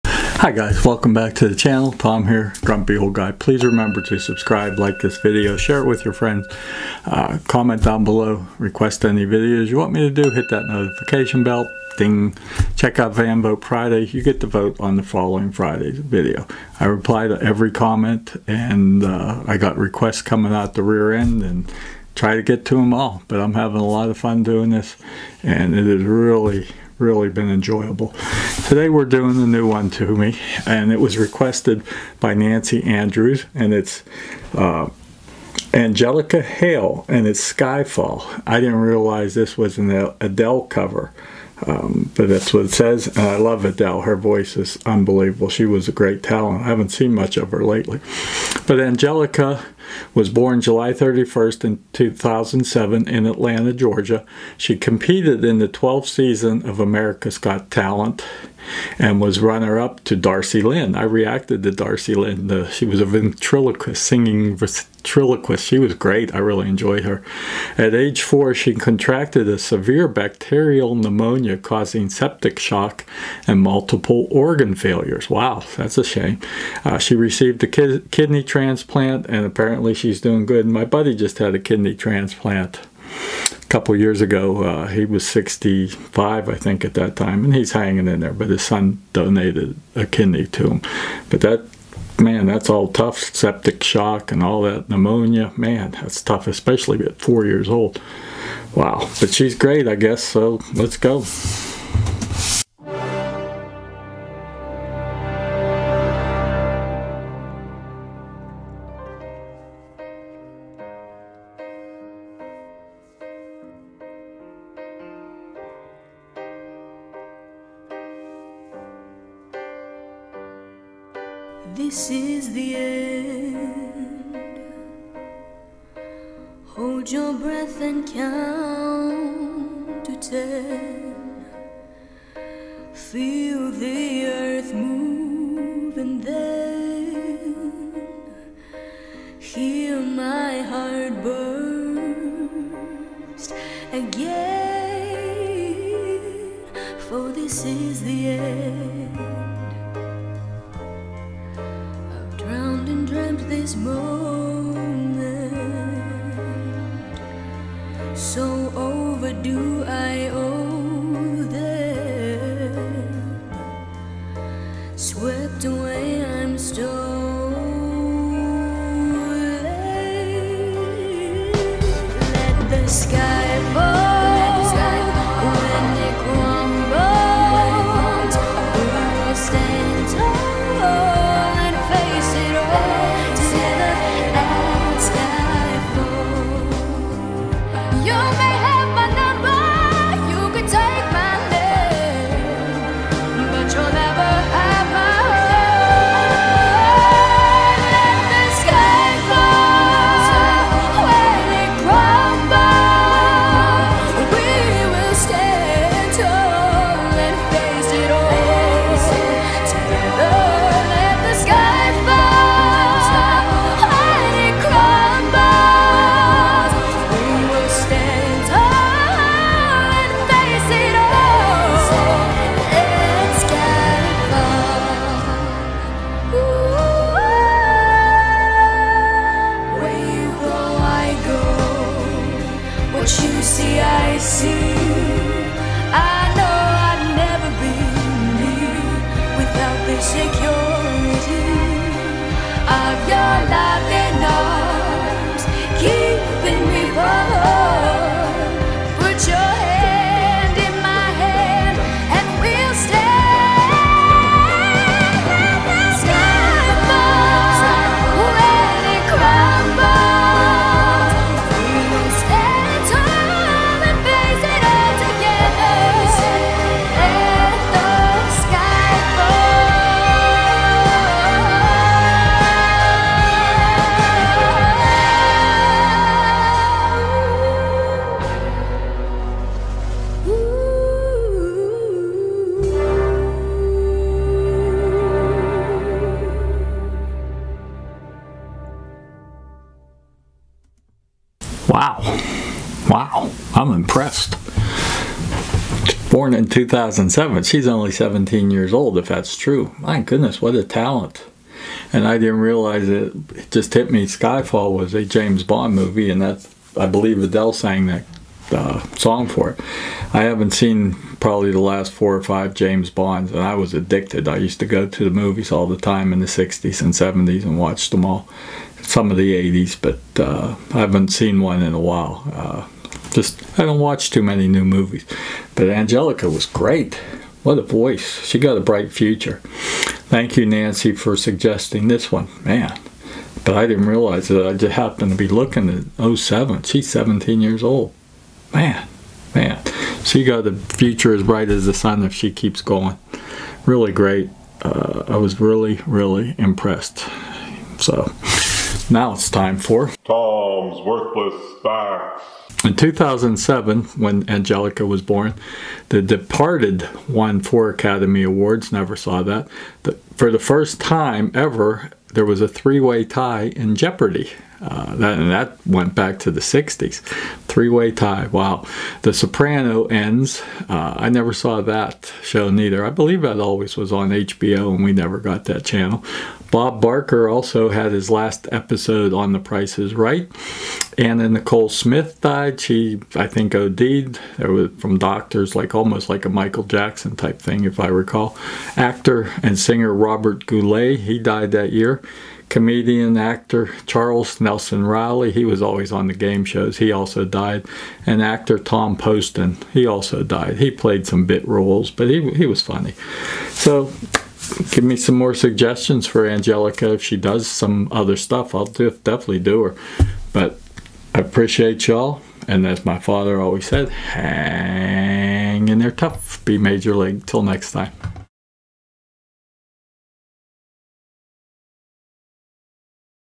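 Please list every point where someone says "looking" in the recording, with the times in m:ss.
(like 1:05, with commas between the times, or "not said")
5:35.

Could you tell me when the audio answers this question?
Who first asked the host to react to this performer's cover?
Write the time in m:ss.
0:32.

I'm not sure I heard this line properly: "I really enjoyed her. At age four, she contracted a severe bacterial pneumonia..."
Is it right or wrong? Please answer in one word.
right.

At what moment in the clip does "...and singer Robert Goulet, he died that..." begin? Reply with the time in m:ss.
6:29.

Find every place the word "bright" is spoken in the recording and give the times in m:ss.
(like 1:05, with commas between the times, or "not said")
5:28, 5:41.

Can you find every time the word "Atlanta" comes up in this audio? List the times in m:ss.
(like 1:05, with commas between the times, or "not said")
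0:53.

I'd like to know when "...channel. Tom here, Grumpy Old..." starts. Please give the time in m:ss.
0:01.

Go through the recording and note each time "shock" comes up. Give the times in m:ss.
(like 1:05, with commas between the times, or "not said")
1:12, 1:33.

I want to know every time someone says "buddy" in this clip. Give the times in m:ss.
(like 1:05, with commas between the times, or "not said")
1:20.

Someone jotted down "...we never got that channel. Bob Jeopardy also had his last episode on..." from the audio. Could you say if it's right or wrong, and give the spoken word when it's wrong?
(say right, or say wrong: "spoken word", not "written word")
wrong: "Barker", not "Jeopardy".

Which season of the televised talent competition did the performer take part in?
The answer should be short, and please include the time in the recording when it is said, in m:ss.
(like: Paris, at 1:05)
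12th, at 0:55.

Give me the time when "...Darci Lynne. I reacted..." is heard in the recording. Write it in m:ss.
1:00.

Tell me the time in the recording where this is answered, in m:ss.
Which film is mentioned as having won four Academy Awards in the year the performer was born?
5:55.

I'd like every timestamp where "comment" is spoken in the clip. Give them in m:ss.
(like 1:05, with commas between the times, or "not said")
0:07, 0:17.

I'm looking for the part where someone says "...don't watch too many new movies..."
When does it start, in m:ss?
5:23.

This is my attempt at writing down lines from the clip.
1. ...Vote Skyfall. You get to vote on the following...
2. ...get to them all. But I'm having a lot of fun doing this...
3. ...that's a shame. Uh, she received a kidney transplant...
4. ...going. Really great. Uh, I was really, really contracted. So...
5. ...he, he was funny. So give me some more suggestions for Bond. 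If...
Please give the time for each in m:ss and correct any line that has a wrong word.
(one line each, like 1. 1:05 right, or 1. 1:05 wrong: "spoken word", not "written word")
1. 0:13 wrong: "Friday", not "Skyfall"
2. 0:22 right
3. 1:15 right
4. 5:42 wrong: "impressed", not "contracted"
5. 6:42 wrong: "Angelica", not "Bond".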